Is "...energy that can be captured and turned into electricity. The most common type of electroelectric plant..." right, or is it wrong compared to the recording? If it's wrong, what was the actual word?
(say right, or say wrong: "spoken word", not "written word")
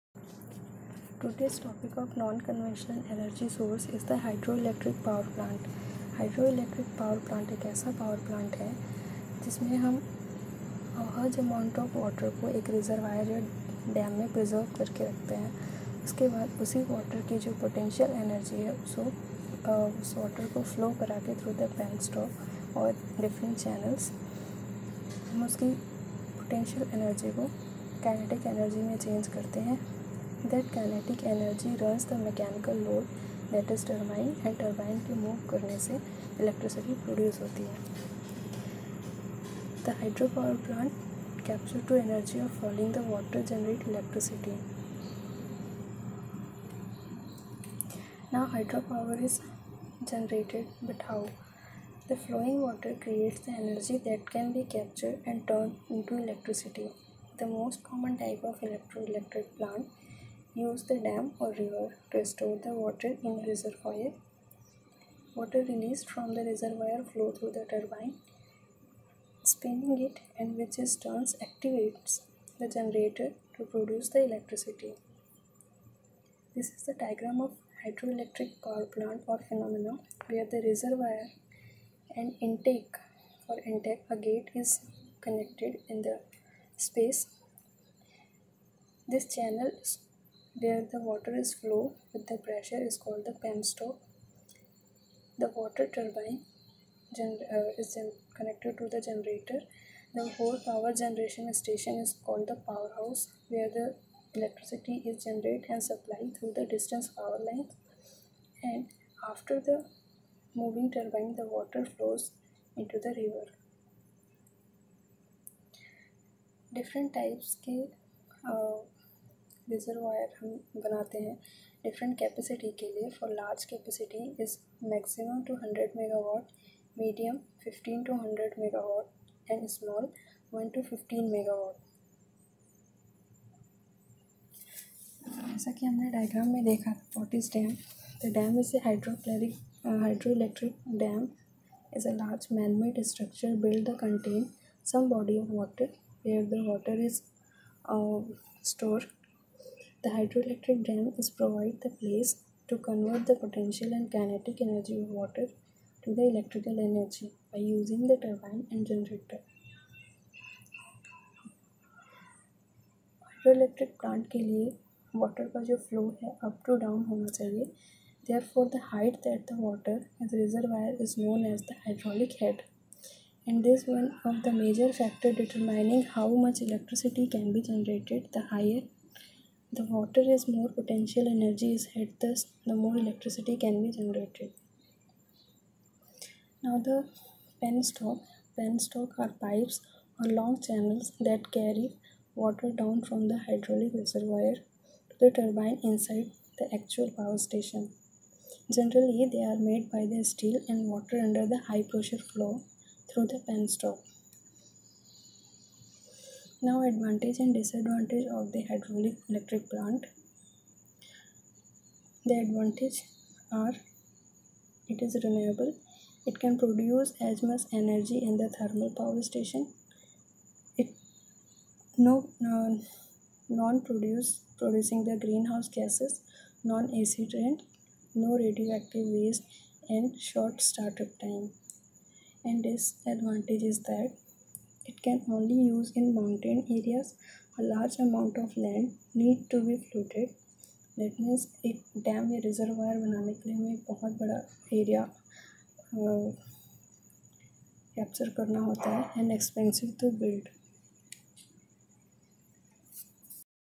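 right.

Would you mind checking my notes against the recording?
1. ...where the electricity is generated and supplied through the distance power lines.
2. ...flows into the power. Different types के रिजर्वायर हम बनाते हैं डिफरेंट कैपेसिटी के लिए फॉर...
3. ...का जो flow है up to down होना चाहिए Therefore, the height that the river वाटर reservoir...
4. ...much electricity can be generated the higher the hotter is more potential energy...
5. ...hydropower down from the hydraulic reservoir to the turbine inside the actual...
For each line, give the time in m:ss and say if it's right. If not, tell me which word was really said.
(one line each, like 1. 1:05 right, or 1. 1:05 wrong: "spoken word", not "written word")
1. 1:43 right
2. 1:51 wrong: "river", not "power"
3. 2:45 wrong: "water", not "river"
4. 2:56 right
5. 3:12 wrong: "water", not "hydropower".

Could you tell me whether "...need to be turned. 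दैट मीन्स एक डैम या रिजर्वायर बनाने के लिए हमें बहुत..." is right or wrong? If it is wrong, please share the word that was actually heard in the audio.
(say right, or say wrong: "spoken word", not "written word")
wrong: "flooded", not "turned".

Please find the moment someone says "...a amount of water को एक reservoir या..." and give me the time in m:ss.
0:11.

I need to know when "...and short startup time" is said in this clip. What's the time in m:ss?
3:49.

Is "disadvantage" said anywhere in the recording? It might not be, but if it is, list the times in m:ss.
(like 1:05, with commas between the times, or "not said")
3:27, 3:52.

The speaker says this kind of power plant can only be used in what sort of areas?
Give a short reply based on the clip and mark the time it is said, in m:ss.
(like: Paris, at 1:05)
mountain areas, at 3:56.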